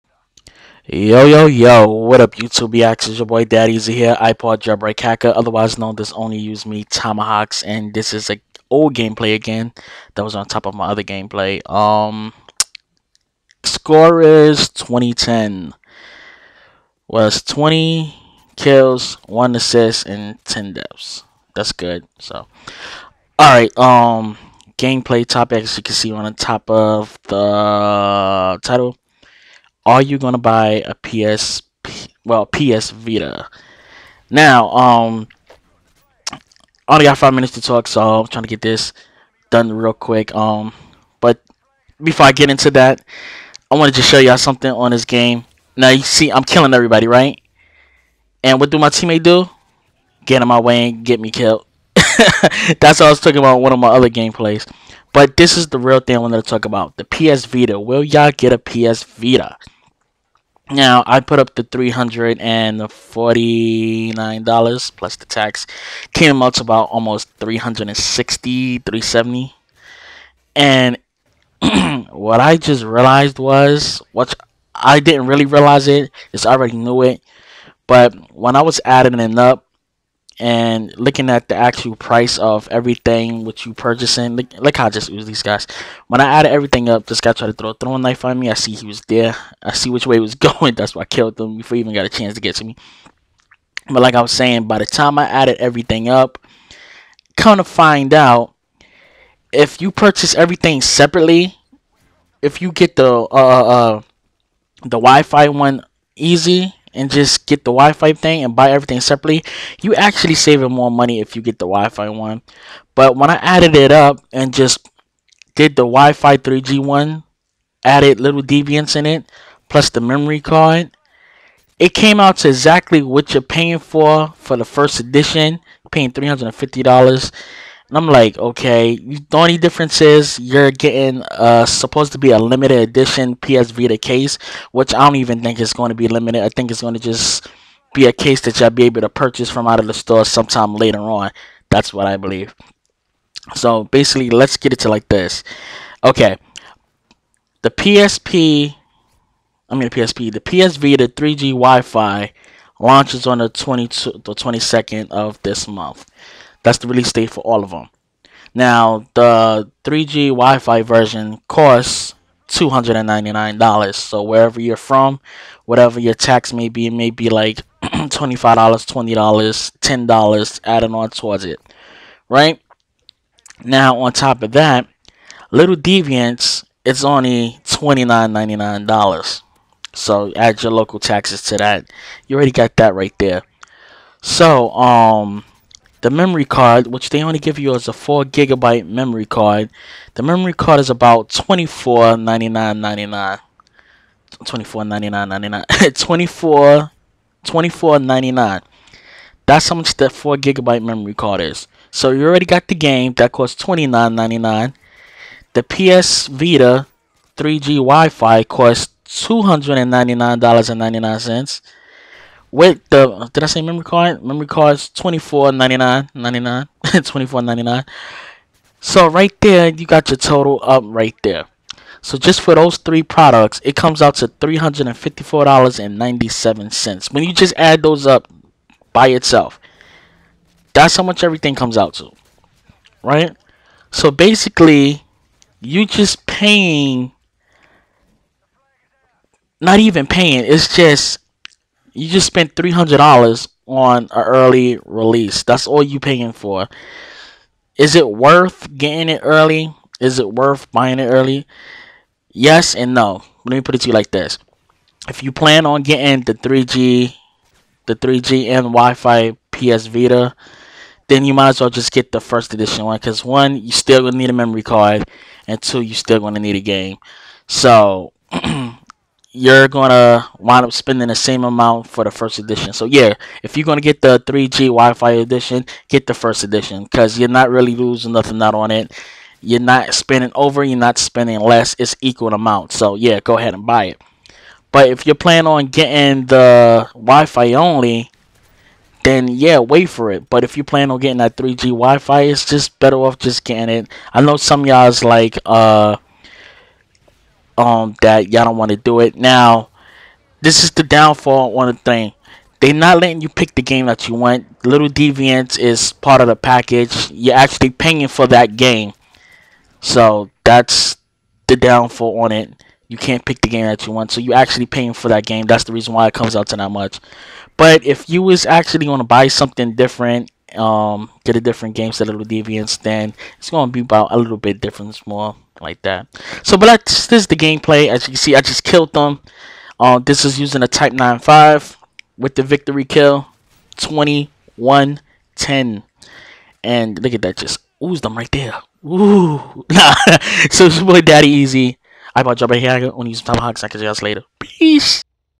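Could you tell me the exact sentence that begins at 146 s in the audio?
Okay, the PSP, I mean the PSP, the PS Vita 3G Wi-Fi launches on the 22, the 22nd of this month.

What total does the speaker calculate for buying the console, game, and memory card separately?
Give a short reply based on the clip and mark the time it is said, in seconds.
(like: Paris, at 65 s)
$354.97, at 224 s.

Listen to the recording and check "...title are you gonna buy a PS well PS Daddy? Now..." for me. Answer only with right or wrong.
wrong.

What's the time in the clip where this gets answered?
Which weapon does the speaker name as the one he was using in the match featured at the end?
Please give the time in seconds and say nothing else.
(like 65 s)
330 s.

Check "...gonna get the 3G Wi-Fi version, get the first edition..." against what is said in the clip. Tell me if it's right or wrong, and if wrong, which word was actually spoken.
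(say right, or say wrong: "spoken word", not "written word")
wrong: "edition", not "version".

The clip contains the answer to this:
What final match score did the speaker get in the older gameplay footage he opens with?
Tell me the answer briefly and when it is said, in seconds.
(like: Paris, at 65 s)
2010, at 13 s.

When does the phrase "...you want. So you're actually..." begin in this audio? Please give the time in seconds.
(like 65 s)
313 s.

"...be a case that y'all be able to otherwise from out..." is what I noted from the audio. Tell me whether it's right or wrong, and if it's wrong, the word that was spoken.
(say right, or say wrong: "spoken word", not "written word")
wrong: "purchase", not "otherwise".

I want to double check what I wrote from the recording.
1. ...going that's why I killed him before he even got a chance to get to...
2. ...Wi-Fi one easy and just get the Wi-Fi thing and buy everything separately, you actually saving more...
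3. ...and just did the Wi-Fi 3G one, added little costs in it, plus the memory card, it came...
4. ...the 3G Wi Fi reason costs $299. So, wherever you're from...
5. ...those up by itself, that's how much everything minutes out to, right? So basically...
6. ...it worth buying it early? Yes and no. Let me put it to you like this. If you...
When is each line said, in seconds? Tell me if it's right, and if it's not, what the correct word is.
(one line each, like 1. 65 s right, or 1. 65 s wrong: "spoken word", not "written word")
1. 90 s right
2. 104 s right
3. 114 s wrong: "deviants", not "costs"
4. 159 s wrong: "version", not "reason"
5. 227 s wrong: "comes", not "minutes"
6. 250 s right.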